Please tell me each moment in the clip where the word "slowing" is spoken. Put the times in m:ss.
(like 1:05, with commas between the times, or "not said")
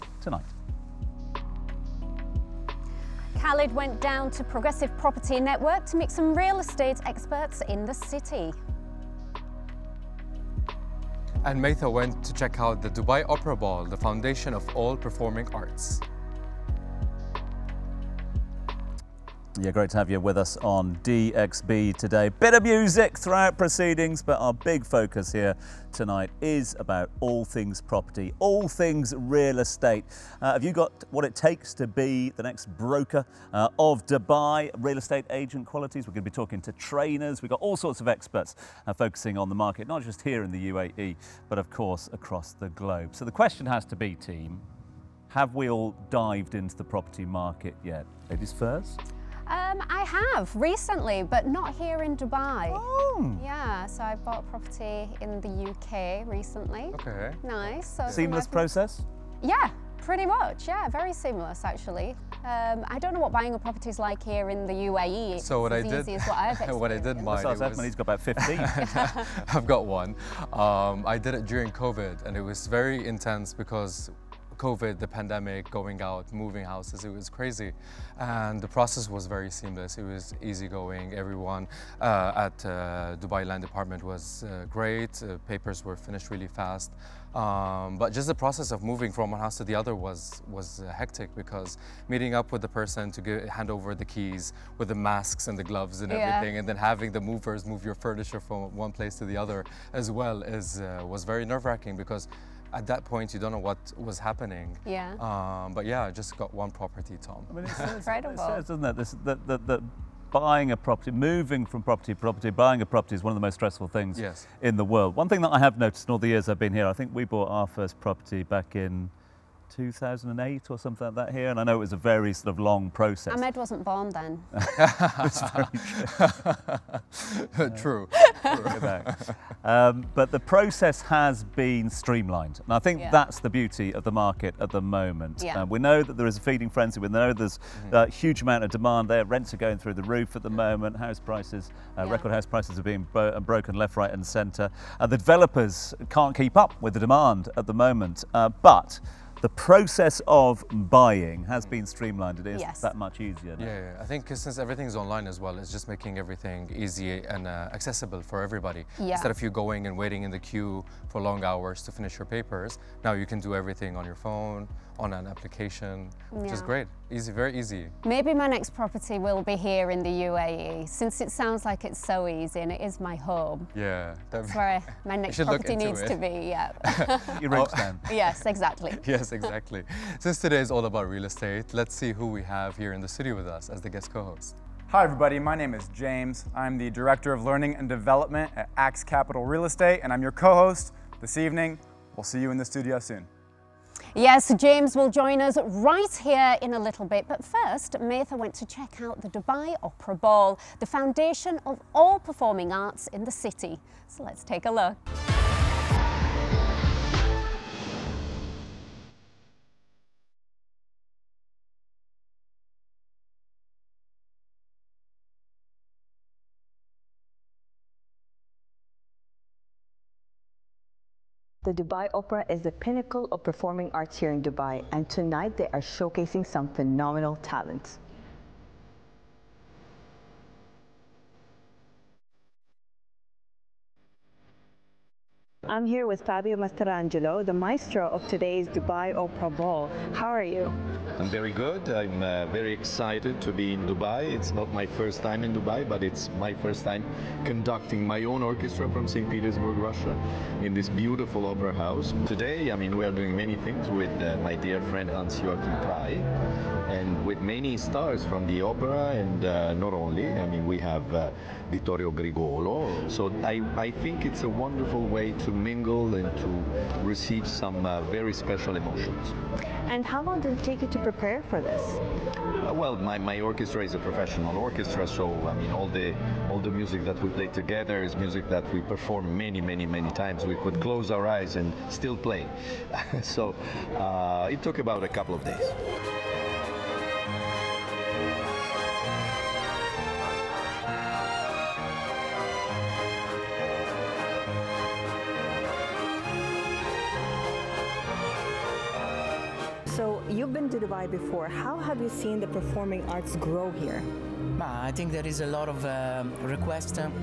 not said.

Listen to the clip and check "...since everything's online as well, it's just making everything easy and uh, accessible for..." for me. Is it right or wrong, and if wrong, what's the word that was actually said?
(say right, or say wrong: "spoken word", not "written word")
right.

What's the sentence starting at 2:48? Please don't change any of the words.
Maybe my next property will be here in the UAE, since it sounds like it's so easy and it is my home.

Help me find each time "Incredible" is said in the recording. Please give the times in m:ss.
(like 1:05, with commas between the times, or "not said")
1:47.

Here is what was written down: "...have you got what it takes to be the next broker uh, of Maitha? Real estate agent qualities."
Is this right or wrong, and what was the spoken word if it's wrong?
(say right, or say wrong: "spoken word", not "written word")
wrong: "Dubai", not "Maitha".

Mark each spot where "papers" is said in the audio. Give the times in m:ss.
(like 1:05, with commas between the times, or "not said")
1:25, 2:42.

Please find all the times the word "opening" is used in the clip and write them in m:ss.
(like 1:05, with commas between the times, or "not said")
not said.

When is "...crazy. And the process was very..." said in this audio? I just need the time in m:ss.
1:17.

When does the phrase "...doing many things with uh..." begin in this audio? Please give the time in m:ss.
4:13.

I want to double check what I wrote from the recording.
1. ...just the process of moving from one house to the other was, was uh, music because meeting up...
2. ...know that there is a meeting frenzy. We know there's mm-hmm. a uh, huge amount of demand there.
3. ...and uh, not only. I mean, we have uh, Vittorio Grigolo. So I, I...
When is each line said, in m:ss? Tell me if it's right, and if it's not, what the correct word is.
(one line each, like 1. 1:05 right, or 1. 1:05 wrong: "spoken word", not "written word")
1. 1:28 wrong: "hectic", not "music"
2. 2:15 wrong: "feeding", not "meeting"
3. 4:19 right.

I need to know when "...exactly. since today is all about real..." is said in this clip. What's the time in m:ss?
2:59.